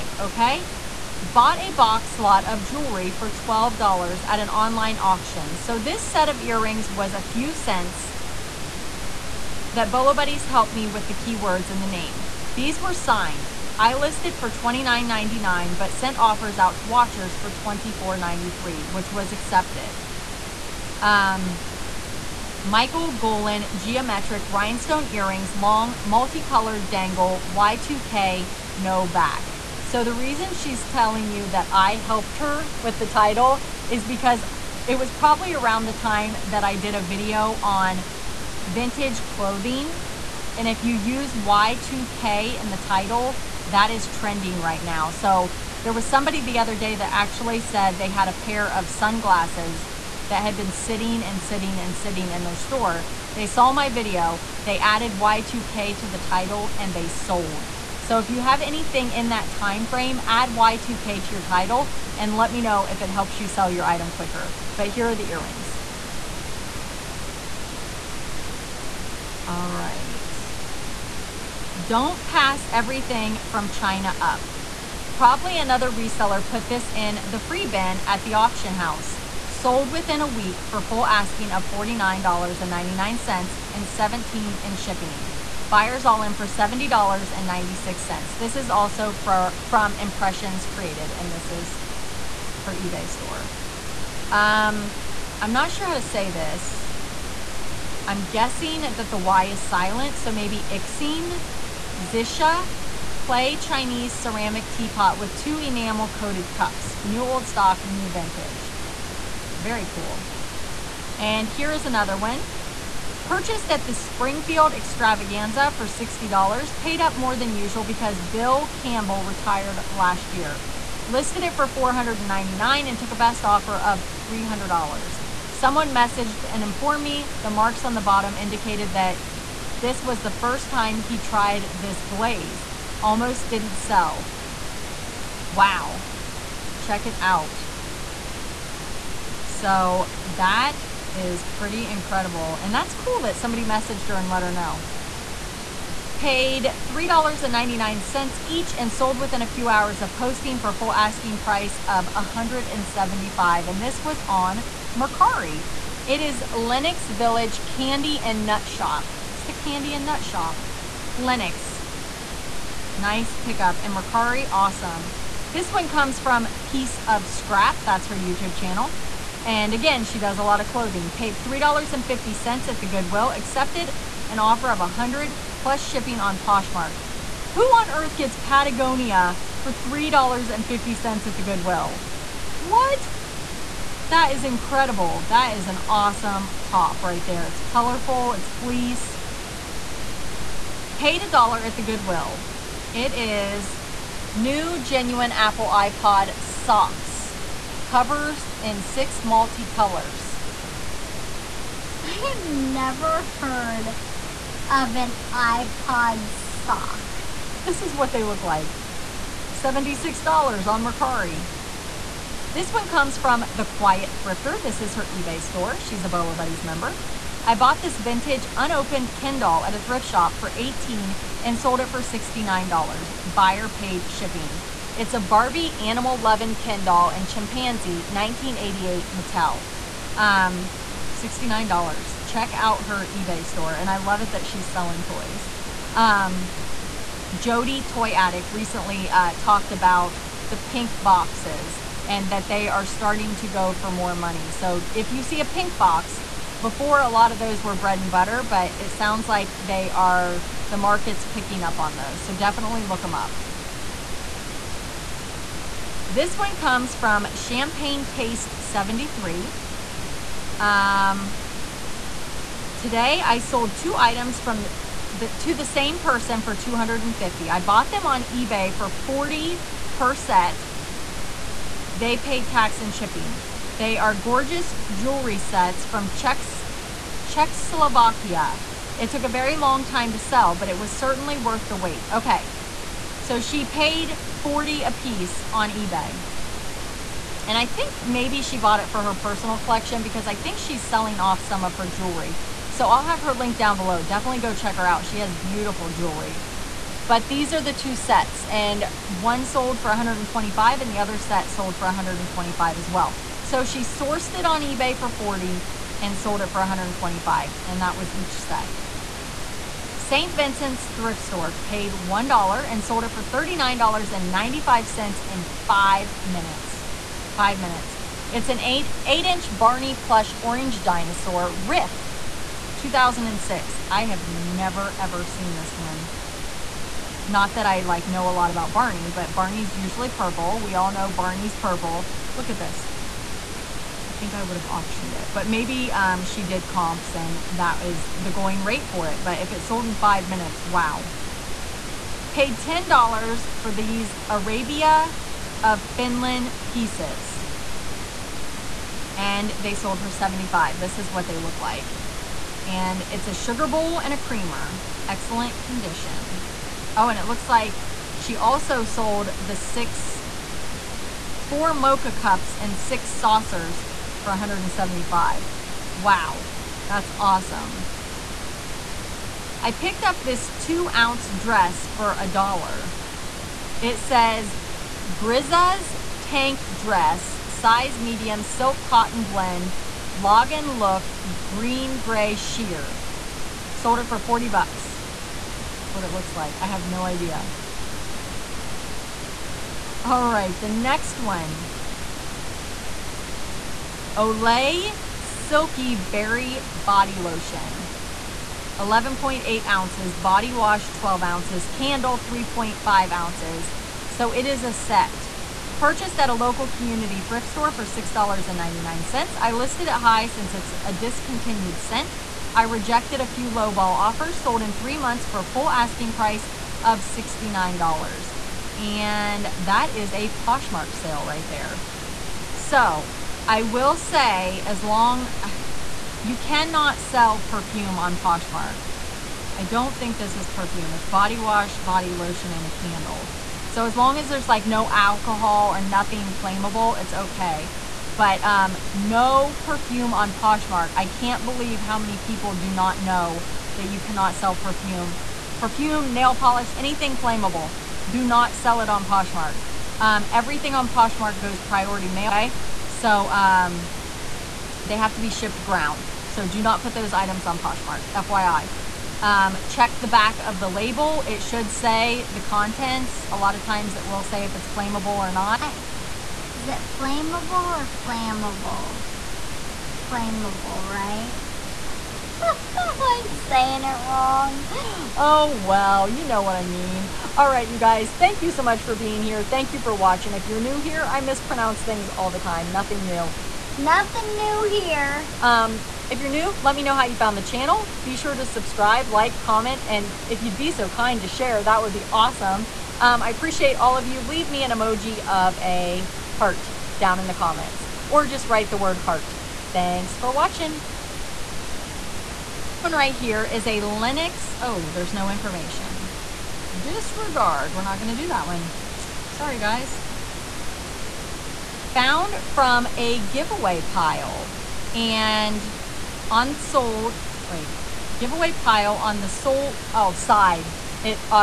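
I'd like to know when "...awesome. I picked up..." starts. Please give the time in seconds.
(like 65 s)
367 s.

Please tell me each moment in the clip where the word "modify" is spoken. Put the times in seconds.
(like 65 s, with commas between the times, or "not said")
not said.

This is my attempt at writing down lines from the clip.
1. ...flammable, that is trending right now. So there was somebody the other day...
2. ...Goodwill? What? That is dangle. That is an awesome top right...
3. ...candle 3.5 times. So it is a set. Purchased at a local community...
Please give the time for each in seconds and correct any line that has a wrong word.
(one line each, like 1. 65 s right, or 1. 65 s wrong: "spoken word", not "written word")
1. 42 s wrong: "title", not "flammable"
2. 181 s wrong: "incredible", not "dangle"
3. 401 s wrong: "ounces", not "times".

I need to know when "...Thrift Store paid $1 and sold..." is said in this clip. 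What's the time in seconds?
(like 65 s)
310 s.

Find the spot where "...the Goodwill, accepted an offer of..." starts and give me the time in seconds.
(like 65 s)
172 s.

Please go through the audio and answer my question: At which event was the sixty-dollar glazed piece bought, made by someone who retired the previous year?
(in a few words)
Springfield Extravaganza.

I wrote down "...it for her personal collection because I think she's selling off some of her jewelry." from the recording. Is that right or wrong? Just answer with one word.
right.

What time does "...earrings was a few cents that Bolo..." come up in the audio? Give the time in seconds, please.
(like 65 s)
6 s.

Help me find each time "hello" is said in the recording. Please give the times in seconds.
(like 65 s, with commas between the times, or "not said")
not said.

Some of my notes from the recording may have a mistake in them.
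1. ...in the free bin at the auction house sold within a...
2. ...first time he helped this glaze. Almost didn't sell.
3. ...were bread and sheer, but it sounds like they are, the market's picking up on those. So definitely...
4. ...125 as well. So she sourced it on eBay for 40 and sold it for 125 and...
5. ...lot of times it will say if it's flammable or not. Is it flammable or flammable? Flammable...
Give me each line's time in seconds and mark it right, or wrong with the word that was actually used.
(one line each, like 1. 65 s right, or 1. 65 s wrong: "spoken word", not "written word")
1. 76 s right
2. 130 s wrong: "tried", not "helped"
3. 247 s wrong: "butter", not "sheer"
4. 301 s right
5. 463 s right.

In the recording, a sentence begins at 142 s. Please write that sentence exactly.
And that's cool that somebody messaged her and let her know.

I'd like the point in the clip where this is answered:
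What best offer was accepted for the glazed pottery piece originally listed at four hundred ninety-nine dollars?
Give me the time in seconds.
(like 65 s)
124 s.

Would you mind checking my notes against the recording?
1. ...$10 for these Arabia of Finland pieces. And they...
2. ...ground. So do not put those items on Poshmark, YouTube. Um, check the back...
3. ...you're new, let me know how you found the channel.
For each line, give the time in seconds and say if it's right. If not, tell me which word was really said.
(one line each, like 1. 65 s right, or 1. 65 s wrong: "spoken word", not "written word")
1. 342 s right
2. 455 s wrong: "FYI", not "YouTube"
3. 486 s right.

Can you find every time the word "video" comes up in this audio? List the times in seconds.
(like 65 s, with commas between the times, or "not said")
37 s, 53 s.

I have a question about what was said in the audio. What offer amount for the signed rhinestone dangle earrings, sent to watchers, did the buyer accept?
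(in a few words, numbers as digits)
$24.93.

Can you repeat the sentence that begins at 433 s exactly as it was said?
So as long as there's like no alcohol or nothing flammable, it's okay.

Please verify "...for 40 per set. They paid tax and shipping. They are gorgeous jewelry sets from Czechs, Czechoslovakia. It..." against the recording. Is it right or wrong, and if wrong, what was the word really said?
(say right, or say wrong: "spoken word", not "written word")
right.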